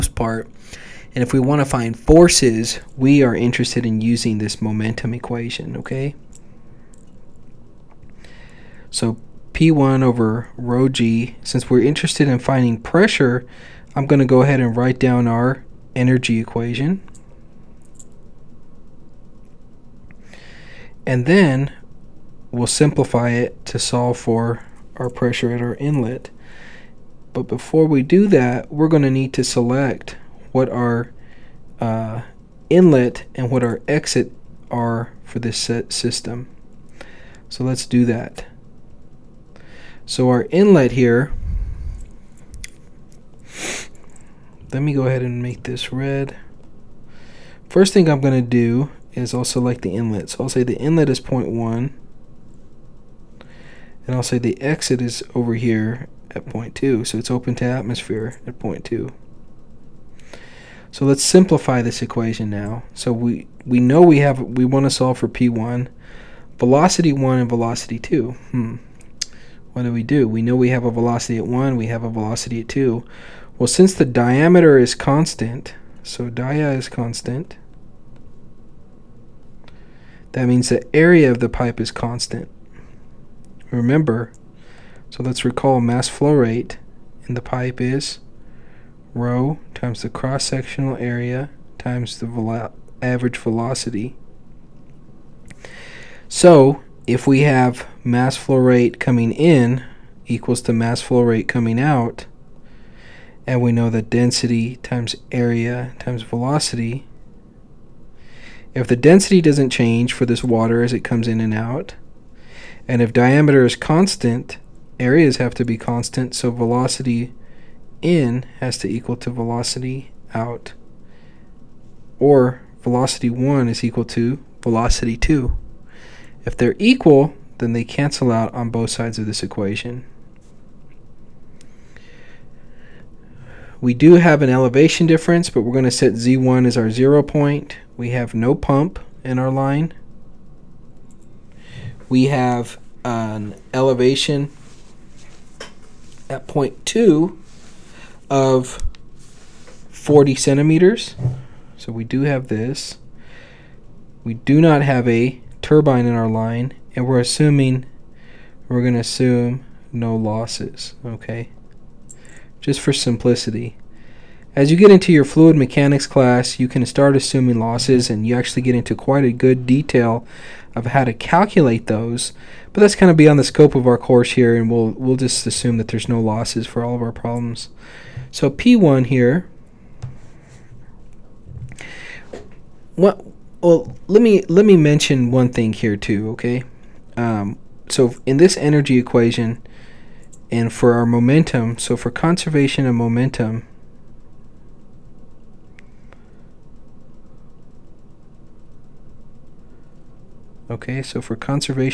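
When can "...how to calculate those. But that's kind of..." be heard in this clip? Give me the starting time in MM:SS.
02:50.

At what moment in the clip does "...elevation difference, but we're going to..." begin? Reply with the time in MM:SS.
02:14.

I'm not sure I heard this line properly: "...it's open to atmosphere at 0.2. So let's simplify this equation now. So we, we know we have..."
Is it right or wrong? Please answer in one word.
right.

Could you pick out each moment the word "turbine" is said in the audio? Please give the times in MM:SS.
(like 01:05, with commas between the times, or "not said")
02:35.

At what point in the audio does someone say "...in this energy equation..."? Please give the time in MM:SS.
03:08.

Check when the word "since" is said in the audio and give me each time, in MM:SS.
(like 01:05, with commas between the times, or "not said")
00:11, 01:13.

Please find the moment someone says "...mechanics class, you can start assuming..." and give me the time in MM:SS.
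02:45.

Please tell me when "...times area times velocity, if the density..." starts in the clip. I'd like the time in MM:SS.
01:44.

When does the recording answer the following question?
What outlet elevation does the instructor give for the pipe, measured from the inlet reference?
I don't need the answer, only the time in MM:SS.
02:29.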